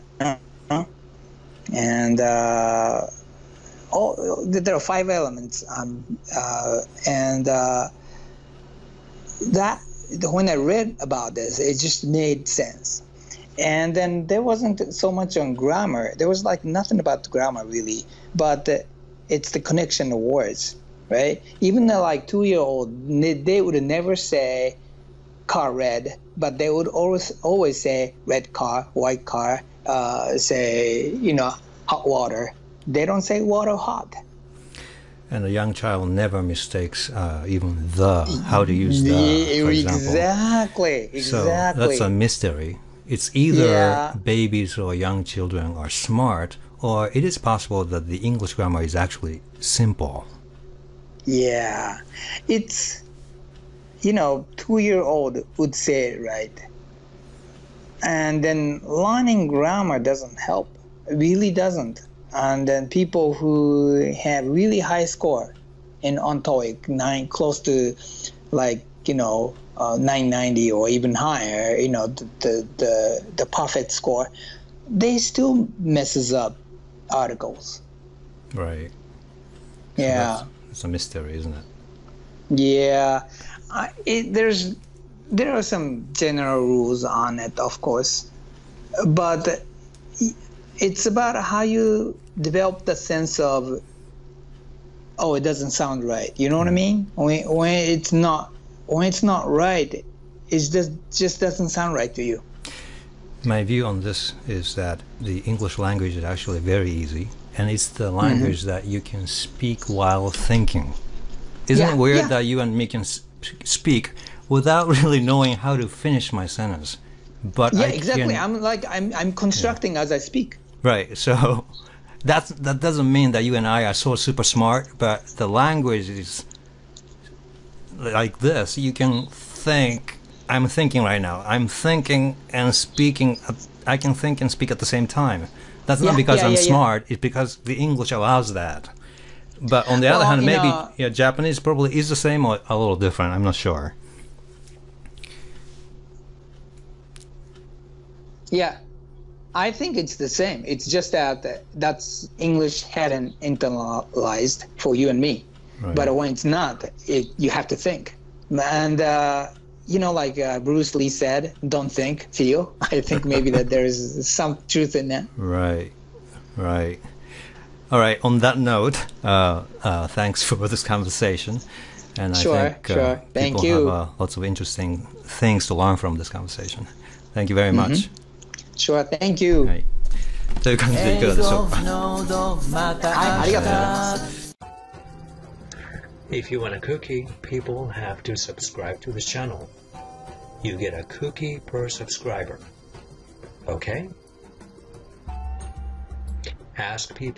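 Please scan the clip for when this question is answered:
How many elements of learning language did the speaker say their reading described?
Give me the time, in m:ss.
0:04.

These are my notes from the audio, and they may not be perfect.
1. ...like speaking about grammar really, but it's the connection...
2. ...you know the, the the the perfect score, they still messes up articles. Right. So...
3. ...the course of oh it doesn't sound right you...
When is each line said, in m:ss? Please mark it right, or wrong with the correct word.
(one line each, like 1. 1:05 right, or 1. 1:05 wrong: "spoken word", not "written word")
1. 0:16 wrong: "nothing", not "speaking"
2. 1:11 right
3. 1:32 wrong: "sense", not "course".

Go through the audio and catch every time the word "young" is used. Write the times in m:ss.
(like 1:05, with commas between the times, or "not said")
0:35, 0:44.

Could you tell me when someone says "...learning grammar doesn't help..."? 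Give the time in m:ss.
0:58.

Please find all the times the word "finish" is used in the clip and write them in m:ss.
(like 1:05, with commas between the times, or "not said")
1:55.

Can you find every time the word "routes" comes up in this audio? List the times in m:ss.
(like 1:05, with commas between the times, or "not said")
not said.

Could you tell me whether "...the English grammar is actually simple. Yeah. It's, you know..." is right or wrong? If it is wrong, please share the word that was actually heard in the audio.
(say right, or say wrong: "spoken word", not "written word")
right.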